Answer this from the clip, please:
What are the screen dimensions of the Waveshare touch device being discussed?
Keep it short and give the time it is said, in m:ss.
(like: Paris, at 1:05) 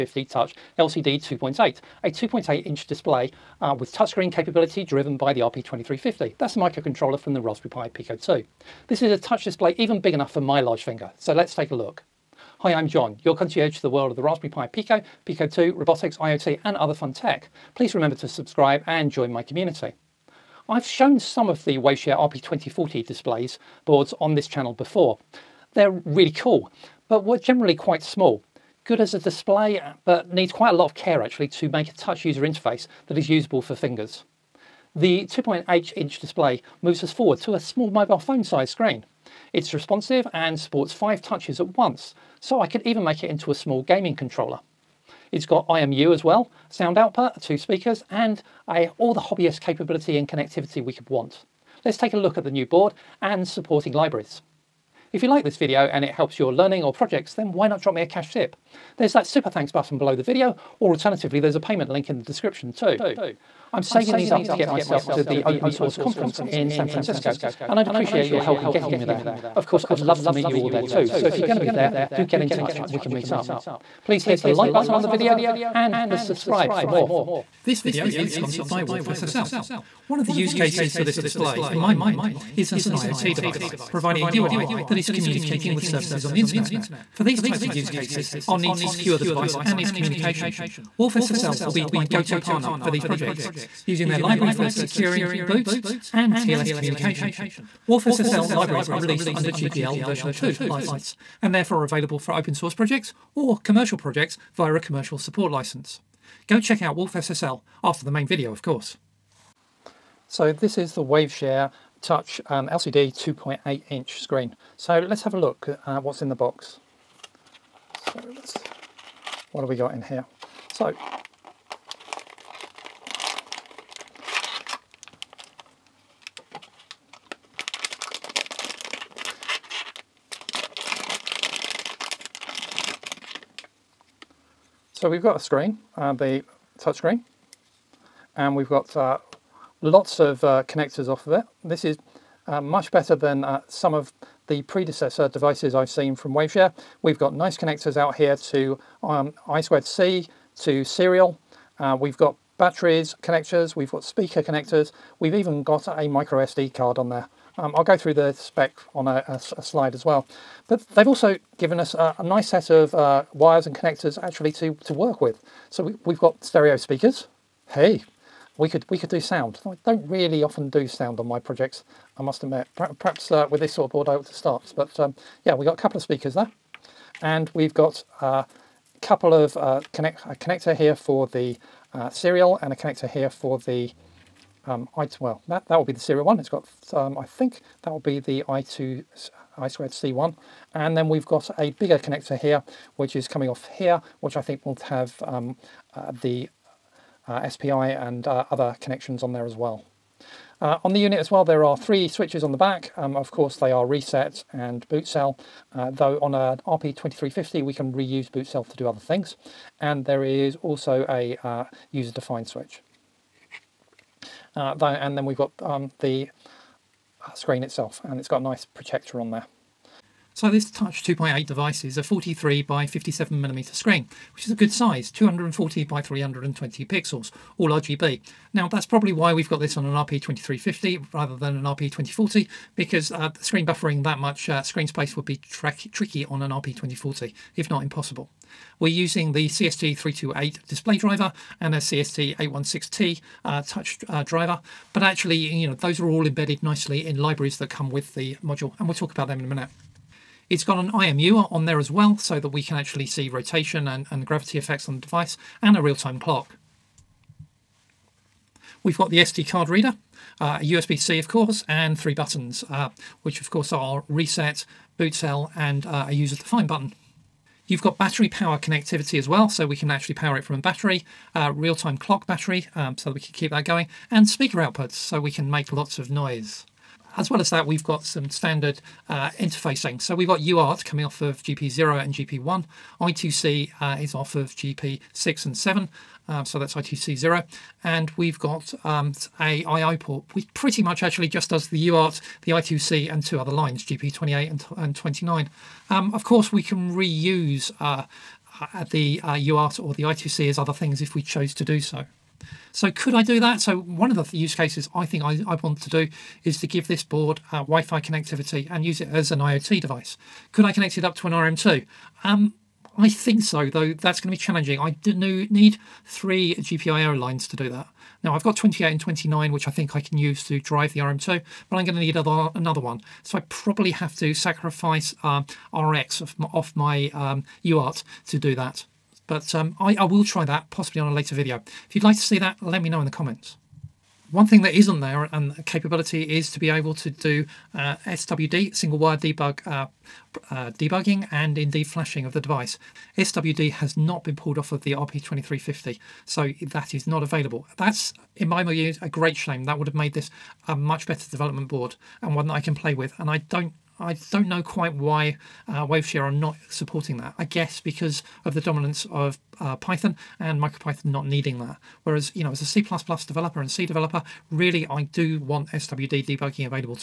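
43 by 57 millimeters, at 3:42.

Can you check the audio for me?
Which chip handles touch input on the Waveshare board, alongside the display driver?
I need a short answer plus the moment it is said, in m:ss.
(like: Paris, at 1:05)
CST816T, at 4:01.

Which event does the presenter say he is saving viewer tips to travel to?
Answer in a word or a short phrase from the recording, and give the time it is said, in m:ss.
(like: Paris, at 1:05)
open source conference, at 1:05.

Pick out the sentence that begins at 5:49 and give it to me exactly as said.
That would have made this a much better development board and one that I can play with.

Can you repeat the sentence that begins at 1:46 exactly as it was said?
Go check out SSL after the main video of course.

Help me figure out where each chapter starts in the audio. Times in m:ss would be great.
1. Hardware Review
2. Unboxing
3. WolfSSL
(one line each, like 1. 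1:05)
1. 3:39
2. 1:49
3. 1:16.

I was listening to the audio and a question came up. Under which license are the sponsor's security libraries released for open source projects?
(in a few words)
GPL version 2.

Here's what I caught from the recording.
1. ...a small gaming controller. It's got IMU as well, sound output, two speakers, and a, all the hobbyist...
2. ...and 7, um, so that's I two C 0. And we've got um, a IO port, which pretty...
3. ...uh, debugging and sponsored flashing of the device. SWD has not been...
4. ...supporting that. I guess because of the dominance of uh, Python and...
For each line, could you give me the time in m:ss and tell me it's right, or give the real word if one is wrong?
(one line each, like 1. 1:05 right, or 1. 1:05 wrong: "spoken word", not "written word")
1. 0:43 right
2. 4:45 right
3. 5:40 wrong: "indeed", not "sponsored"
4. 5:56 right.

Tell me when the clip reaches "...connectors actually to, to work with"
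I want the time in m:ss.
2:43.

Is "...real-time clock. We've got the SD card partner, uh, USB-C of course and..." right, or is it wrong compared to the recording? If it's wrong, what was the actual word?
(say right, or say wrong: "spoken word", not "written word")
wrong: "reader", not "partner".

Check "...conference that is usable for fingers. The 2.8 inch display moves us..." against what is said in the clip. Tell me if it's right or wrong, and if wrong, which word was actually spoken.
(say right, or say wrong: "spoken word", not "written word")
wrong: "interface", not "conference".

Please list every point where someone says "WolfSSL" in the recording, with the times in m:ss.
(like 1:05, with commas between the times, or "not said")
1:18, 1:30.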